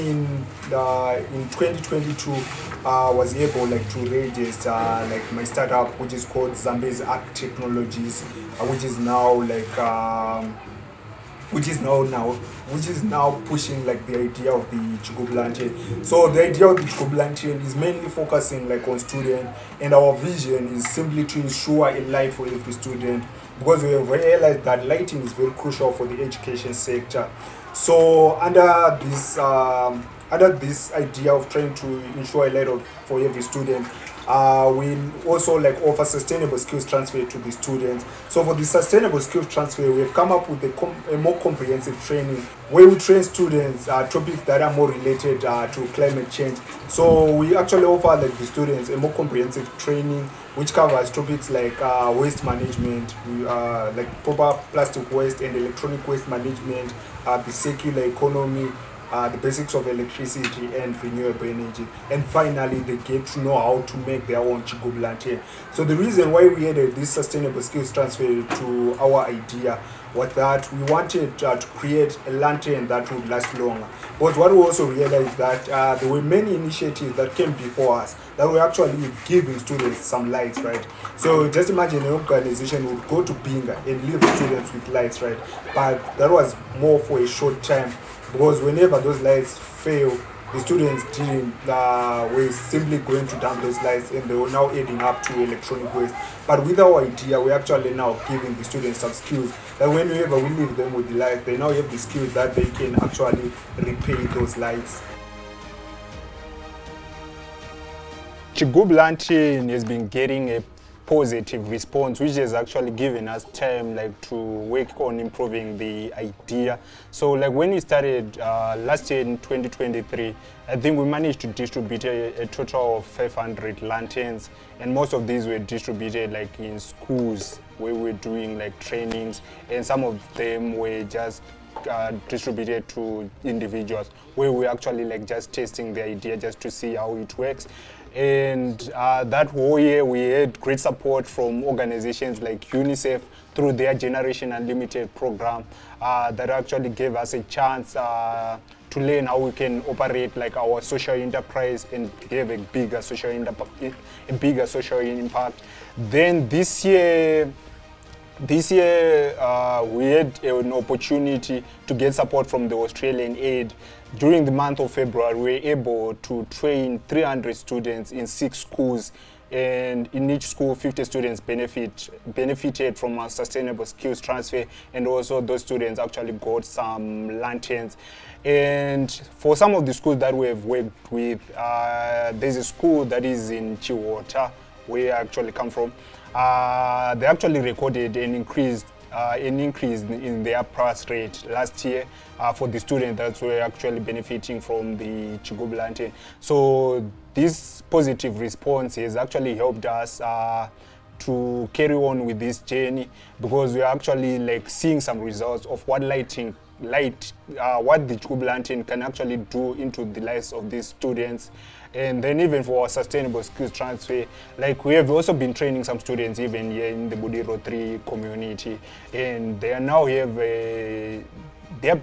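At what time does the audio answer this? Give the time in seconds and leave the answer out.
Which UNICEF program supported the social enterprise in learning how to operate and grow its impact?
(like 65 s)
143 s.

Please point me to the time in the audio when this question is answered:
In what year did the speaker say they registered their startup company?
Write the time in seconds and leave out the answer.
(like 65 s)
1 s.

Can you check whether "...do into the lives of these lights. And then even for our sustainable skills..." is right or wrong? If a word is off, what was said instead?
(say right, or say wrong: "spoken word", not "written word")
wrong: "students", not "lights".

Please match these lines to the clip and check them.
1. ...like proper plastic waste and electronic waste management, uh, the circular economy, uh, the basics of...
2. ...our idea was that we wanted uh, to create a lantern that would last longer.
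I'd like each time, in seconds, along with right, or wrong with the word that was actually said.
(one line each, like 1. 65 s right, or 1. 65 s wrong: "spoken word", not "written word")
1. 53 s right
2. 68 s right.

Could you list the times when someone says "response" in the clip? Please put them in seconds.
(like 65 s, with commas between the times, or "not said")
111 s, 198 s.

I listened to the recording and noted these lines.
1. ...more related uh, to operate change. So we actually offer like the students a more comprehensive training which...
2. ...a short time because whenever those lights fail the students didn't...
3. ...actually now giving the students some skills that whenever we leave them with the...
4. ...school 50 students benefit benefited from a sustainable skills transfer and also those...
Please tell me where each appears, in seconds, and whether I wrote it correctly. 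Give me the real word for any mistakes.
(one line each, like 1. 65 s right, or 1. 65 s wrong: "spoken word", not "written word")
1. 44 s wrong: "climate", not "operate"
2. 87 s right
3. 97 s right
4. 170 s right.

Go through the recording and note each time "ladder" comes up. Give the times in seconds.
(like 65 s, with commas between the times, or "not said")
32 s.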